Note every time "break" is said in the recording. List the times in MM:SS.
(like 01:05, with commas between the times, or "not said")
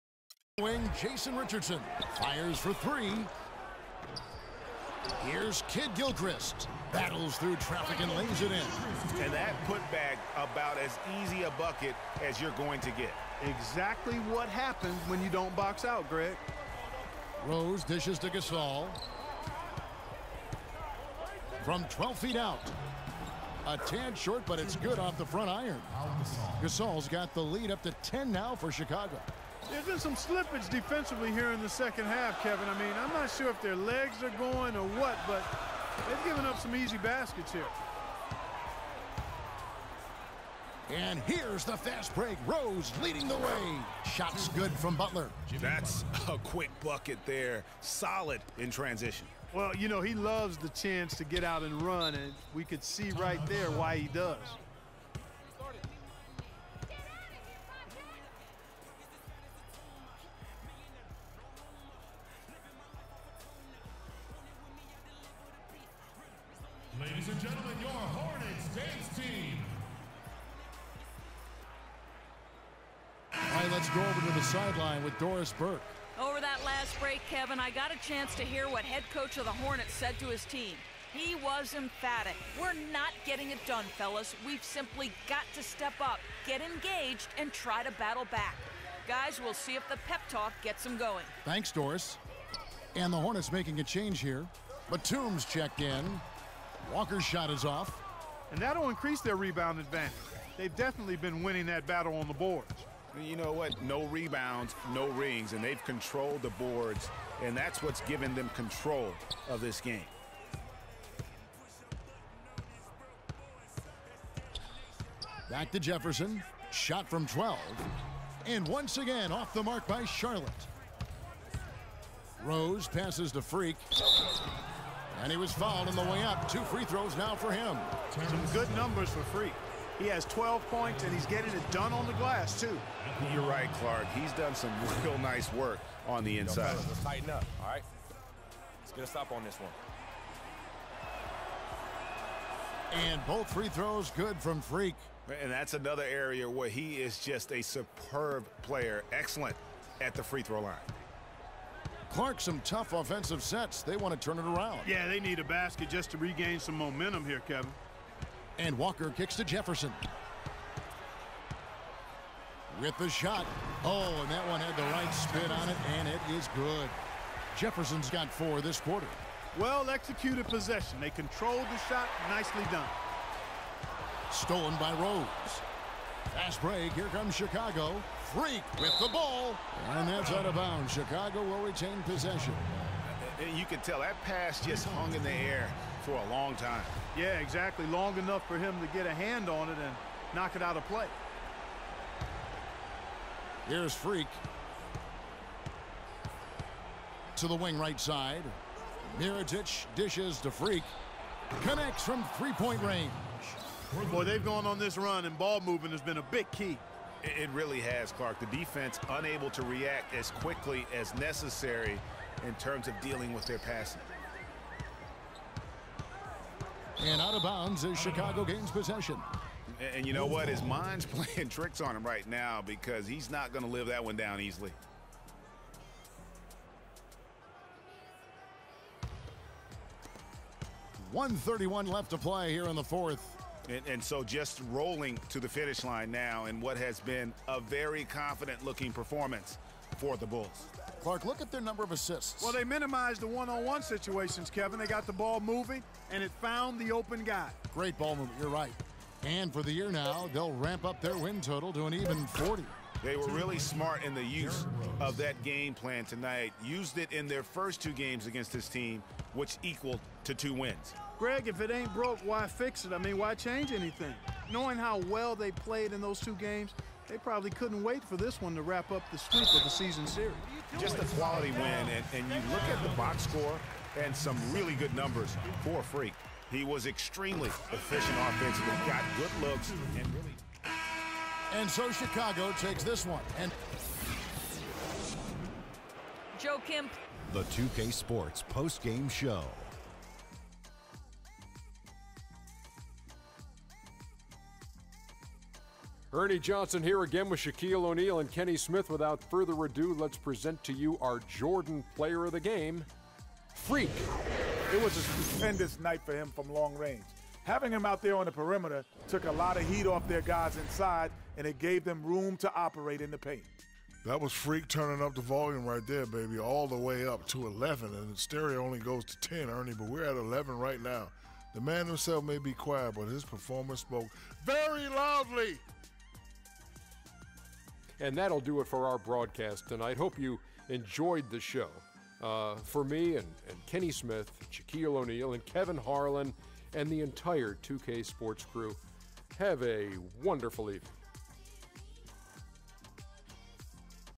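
00:42, 01:16, 02:56.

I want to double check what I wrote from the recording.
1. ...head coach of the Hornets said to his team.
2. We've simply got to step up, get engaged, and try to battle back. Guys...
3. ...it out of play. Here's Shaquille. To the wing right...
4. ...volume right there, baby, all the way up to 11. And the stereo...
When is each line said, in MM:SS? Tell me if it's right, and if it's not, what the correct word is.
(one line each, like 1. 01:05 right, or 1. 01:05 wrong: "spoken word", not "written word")
1. 01:18 right
2. 01:24 right
3. 03:10 wrong: "Freak", not "Shaquille"
4. 05:15 right.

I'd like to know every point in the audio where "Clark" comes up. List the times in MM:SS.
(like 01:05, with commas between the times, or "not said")
02:13, 02:32, 03:28, 04:01.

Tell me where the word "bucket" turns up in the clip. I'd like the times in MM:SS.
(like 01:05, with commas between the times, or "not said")
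00:11, 00:46.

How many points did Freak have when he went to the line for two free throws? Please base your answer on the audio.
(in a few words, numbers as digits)
12.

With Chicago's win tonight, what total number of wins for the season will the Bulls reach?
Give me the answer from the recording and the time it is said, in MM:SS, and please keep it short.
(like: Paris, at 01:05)
40, at 04:11.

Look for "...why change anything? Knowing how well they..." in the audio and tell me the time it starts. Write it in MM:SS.
04:23.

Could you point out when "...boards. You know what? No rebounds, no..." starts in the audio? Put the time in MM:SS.
01:42.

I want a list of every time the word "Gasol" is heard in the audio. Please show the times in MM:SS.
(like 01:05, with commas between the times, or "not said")
00:18, 00:26.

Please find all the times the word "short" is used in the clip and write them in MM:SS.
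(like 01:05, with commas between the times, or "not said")
00:24.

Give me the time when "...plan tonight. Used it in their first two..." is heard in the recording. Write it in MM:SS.
04:15.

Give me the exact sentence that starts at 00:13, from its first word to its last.
Exactly what happens when you don't box out, Greg.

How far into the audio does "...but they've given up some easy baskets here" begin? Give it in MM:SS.
00:35.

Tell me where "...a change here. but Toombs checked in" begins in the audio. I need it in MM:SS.
01:33.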